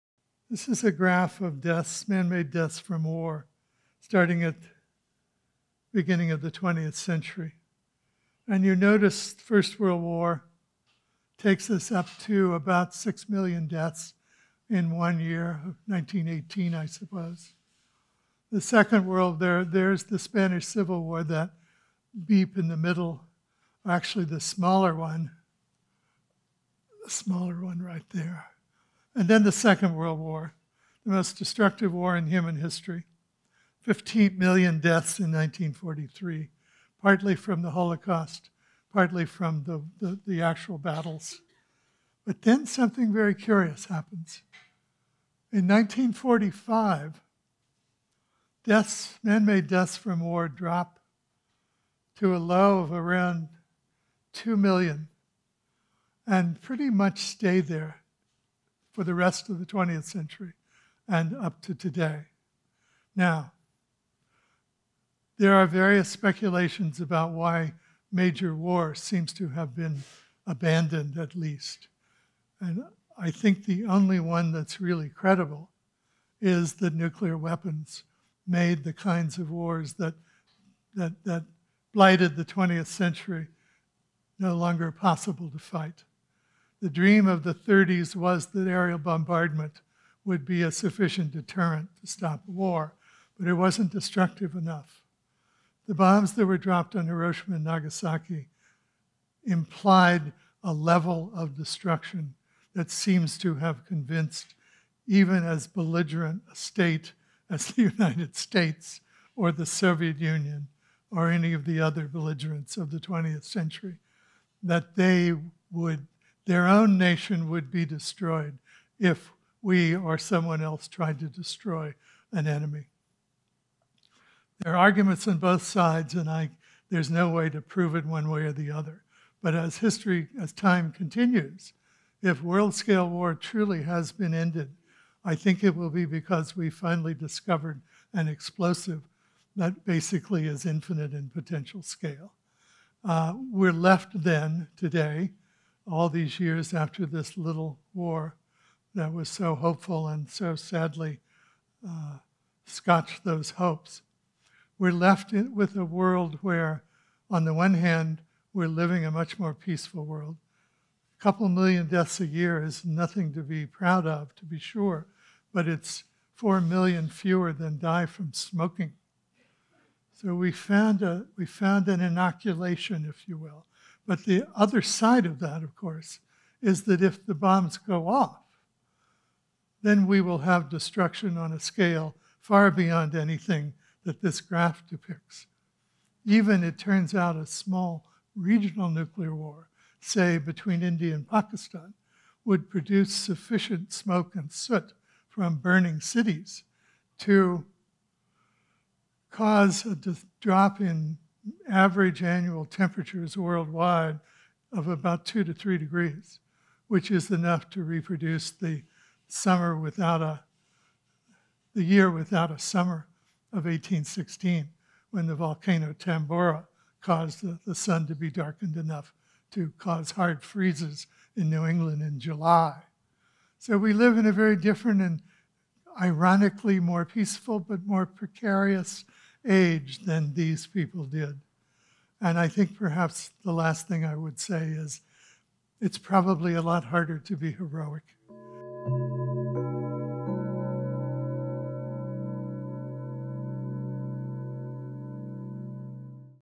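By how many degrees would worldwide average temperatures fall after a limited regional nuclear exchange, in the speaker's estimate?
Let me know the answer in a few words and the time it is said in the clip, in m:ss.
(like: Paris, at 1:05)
2 to 3 degrees, at 3:25.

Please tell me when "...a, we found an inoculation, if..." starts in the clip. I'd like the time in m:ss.
2:51.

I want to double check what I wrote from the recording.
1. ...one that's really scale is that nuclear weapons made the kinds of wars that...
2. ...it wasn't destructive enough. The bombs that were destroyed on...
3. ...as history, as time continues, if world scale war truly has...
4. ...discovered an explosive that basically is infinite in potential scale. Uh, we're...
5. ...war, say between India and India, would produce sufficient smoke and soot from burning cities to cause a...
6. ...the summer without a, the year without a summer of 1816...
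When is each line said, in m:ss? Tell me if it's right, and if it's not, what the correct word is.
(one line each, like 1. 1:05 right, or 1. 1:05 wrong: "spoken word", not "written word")
1. 1:14 wrong: "credible", not "scale"
2. 1:33 wrong: "dropped", not "destroyed"
3. 2:09 right
4. 2:17 right
5. 3:09 wrong: "Pakistan", not "India"
6. 3:28 right.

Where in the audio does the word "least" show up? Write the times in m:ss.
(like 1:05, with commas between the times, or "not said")
1:11.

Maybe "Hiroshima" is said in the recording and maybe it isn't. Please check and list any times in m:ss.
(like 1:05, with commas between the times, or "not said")
1:37.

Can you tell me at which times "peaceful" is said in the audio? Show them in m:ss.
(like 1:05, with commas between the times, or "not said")
2:39, 3:47.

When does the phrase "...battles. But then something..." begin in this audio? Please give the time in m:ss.
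0:40.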